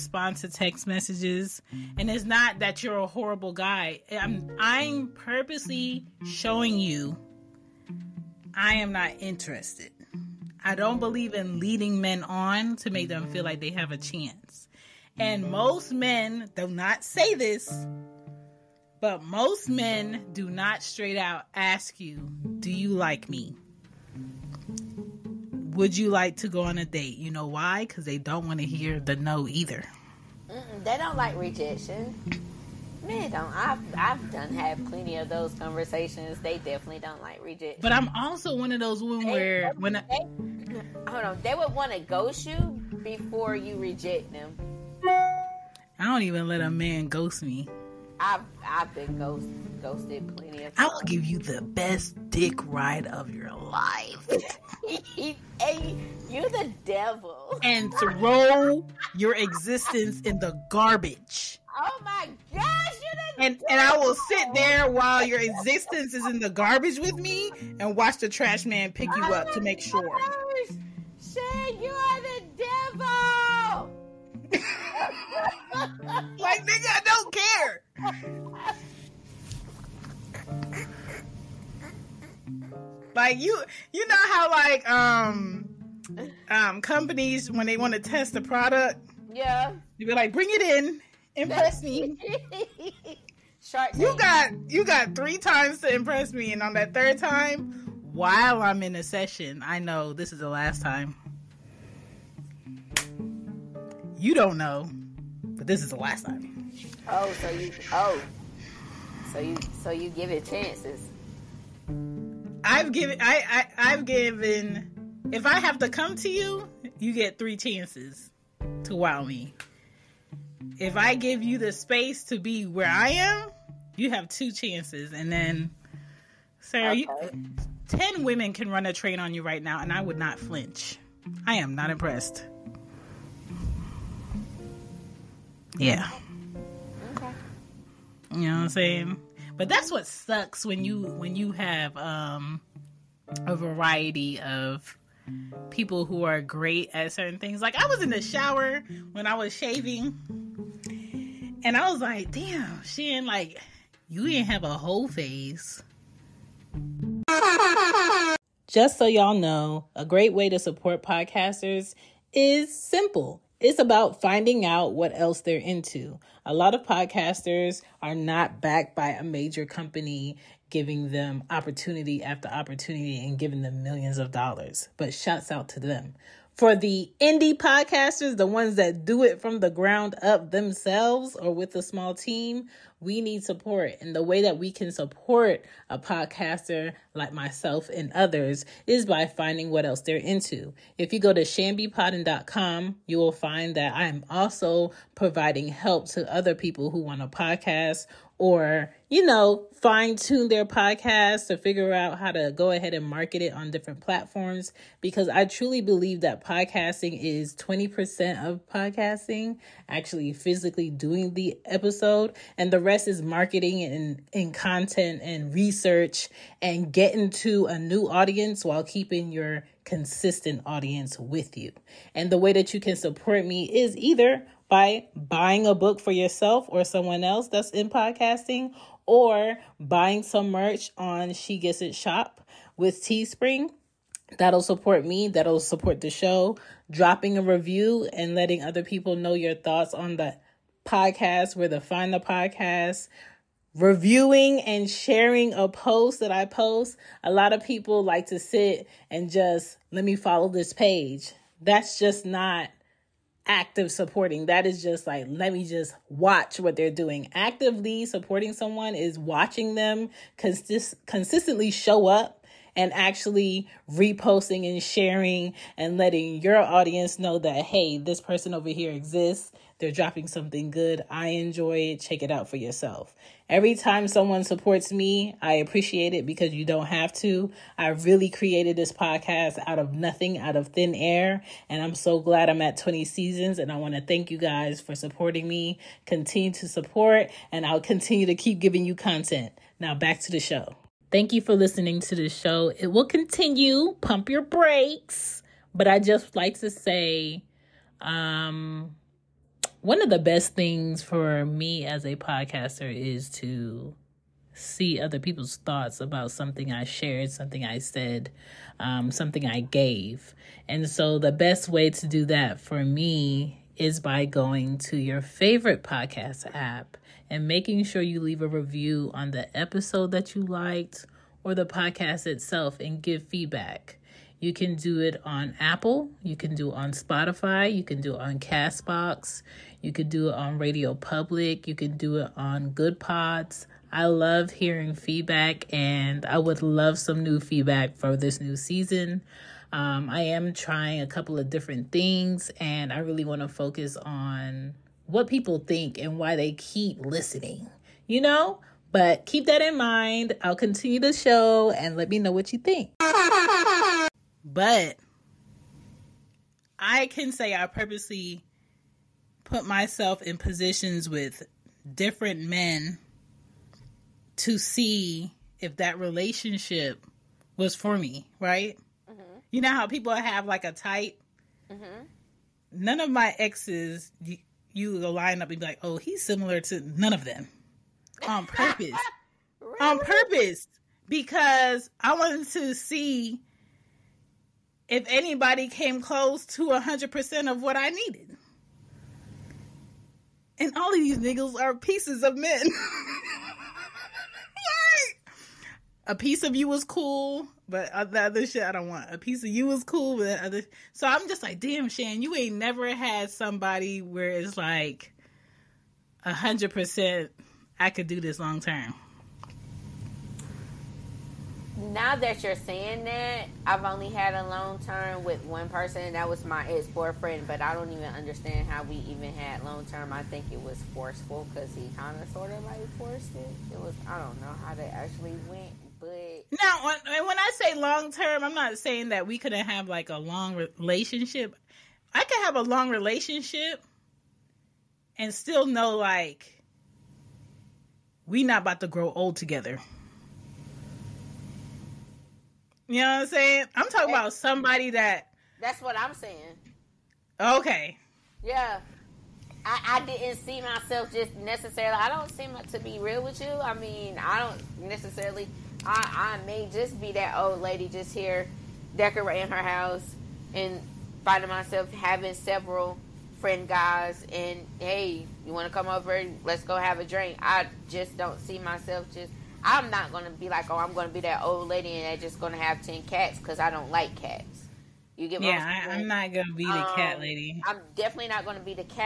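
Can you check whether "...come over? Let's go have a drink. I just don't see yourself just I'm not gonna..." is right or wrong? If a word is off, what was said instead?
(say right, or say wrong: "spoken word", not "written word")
wrong: "myself", not "yourself".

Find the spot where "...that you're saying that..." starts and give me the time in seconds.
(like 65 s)
412 s.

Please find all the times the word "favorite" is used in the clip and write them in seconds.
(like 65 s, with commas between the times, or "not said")
315 s.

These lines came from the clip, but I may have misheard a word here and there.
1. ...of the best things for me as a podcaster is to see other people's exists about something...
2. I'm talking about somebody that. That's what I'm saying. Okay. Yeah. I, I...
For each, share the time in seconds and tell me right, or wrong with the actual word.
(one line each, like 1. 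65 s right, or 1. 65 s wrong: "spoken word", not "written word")
1. 300 s wrong: "thoughts", not "exists"
2. 443 s right.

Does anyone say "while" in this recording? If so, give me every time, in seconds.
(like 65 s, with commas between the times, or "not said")
64 s, 98 s, 218 s.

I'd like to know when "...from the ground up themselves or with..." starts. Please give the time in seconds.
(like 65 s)
179 s.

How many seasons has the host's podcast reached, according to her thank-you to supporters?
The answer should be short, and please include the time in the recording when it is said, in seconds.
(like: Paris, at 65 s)
20, at 282 s.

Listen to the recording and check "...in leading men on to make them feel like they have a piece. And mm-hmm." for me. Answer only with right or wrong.
wrong.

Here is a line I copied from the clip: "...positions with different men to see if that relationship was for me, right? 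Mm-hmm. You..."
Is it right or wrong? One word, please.
right.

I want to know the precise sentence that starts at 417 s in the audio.
But I don't even understand how we even had long term.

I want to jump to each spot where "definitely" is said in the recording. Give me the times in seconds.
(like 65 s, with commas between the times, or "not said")
36 s, 477 s.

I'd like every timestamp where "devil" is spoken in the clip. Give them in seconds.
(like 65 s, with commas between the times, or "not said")
56 s, 63 s.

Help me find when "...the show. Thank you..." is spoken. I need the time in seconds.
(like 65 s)
290 s.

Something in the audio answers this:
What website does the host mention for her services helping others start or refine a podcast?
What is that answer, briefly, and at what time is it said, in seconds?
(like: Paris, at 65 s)
chanbepoddin.com, at 191 s.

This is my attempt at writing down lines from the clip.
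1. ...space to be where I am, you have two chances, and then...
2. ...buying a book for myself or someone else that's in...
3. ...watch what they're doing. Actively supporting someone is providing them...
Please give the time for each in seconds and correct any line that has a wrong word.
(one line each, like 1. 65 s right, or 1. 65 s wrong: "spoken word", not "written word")
1. 121 s right
2. 225 s wrong: "yourself", not "myself"
3. 256 s wrong: "watching", not "providing".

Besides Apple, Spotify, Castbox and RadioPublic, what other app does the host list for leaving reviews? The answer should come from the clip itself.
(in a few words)
Goodpods.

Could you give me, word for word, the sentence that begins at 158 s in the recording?
Just so y'all know, a great way to support podcasters is simple it's about finding out what else they're into.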